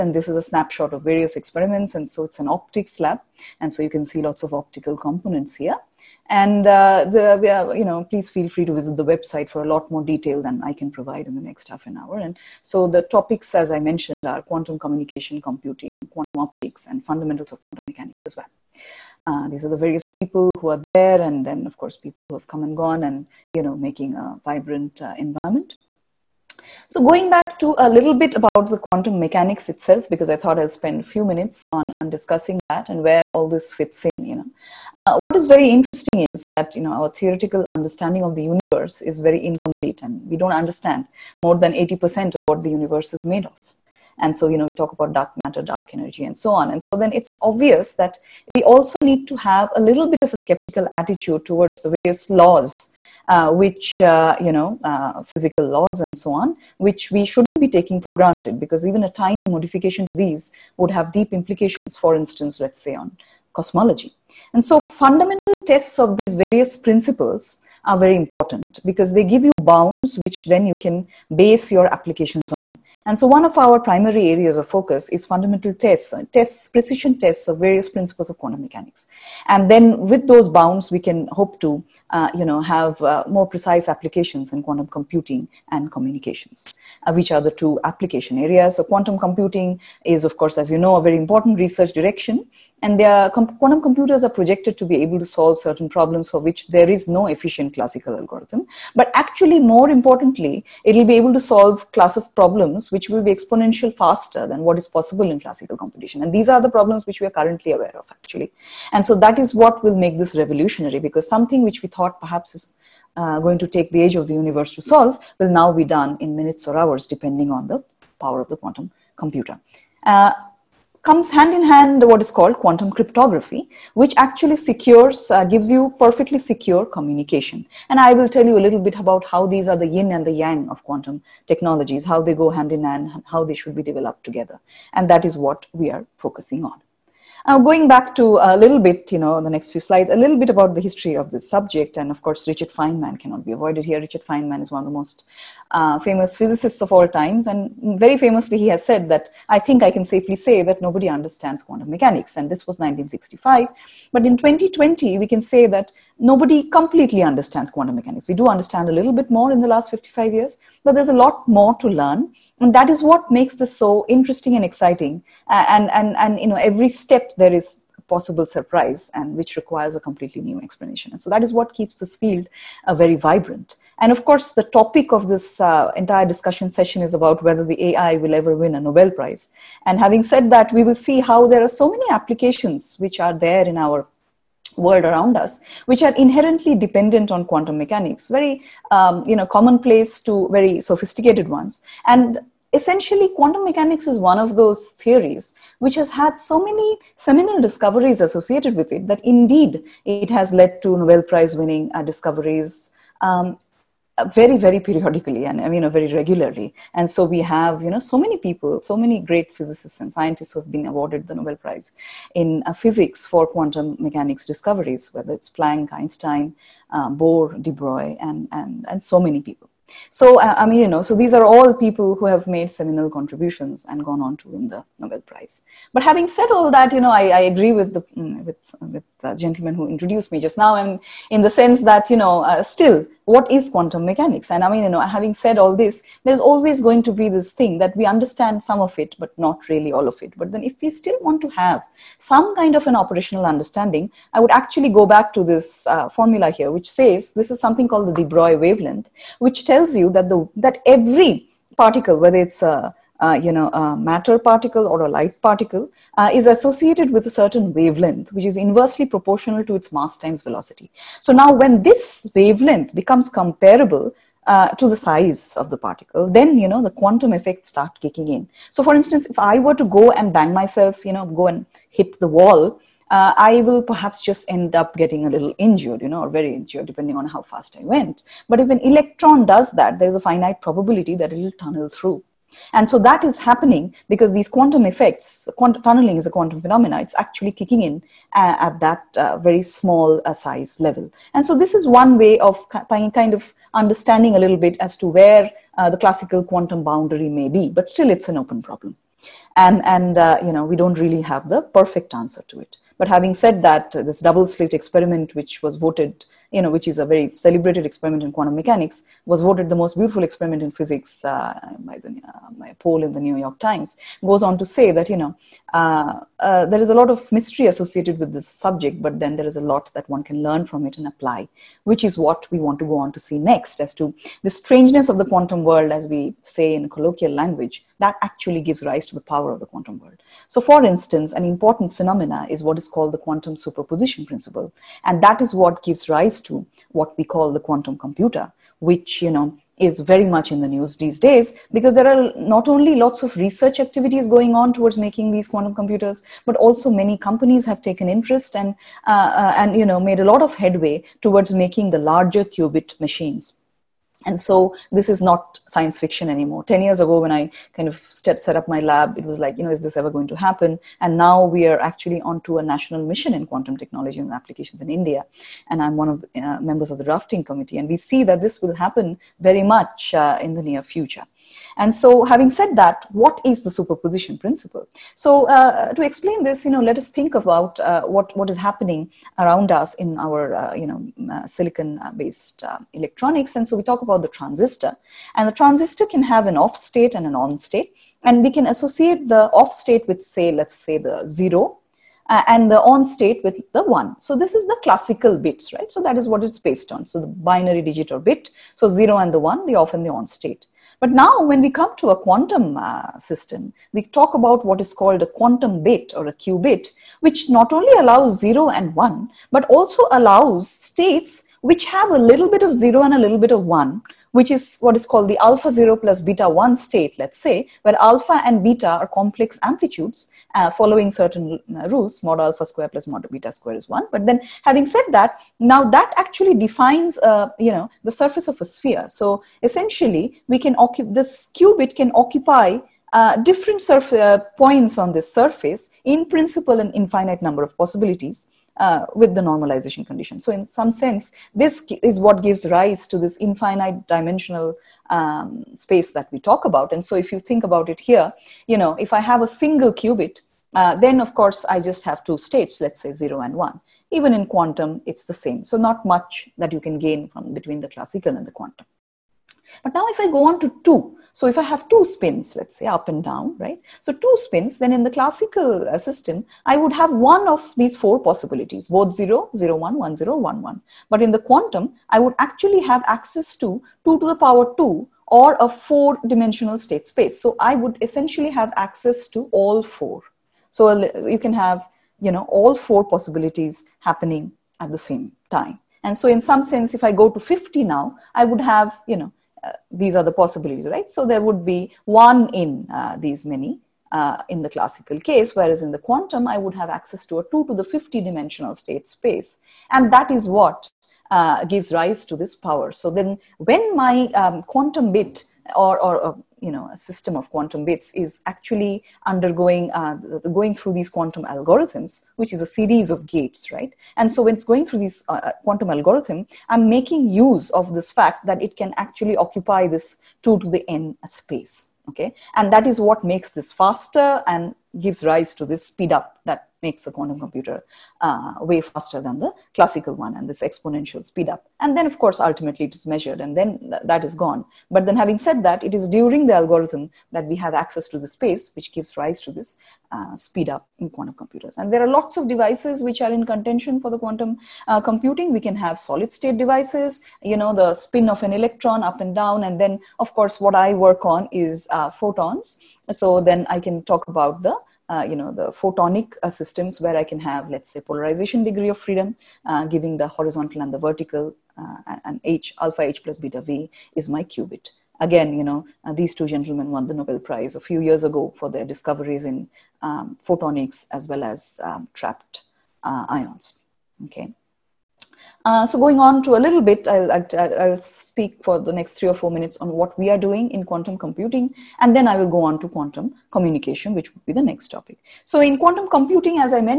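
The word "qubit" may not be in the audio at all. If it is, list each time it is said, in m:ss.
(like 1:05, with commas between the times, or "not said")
5:52, 6:46, 7:11, 7:29, 9:24.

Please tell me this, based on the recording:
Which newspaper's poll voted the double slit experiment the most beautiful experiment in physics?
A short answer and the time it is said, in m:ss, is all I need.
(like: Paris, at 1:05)
The New York Times, at 5:13.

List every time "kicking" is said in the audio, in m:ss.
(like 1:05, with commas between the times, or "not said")
4:28, 4:47.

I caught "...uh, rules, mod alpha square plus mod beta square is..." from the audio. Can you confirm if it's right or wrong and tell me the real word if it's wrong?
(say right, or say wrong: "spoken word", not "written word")
right.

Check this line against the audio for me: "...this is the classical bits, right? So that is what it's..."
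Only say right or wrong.
right.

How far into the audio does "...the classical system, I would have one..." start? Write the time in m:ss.
7:45.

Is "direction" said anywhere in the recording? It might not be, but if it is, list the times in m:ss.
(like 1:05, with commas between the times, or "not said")
1:31.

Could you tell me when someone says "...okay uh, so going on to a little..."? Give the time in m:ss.
9:34.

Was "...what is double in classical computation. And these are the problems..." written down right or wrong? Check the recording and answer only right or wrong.
wrong.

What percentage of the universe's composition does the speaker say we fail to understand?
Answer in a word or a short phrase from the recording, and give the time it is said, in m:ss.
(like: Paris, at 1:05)
more than 80%, at 0:41.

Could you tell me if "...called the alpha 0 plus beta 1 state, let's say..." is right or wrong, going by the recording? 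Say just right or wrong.
right.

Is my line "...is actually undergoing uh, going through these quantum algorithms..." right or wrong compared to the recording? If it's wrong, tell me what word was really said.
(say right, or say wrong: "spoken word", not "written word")
right.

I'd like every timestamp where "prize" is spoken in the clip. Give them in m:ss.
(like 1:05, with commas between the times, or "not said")
2:59, 3:21, 3:31, 3:45, 9:27.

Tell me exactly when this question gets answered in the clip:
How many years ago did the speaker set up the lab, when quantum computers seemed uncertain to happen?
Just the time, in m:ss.
5:56.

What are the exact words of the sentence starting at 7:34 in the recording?
Even in quantum, it's the same.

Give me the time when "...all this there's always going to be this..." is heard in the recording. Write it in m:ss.
3:55.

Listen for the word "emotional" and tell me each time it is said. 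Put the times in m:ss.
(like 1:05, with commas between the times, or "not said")
not said.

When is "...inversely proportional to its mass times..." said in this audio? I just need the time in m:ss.
4:18.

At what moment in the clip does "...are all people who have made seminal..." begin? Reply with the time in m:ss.
3:41.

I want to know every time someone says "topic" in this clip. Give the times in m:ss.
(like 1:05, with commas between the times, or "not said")
0:13, 2:54, 9:44.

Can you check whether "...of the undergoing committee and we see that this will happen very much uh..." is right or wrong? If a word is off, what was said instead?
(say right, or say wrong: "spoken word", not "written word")
wrong: "drafting", not "undergoing".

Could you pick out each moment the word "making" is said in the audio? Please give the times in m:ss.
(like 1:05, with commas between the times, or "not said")
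0:23, 5:44, 5:51, 8:36.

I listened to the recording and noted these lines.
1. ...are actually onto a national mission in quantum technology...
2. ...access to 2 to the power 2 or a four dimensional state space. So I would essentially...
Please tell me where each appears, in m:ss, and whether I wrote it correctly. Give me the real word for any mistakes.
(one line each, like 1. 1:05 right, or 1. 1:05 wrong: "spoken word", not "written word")
1. 6:01 right
2. 7:53 right.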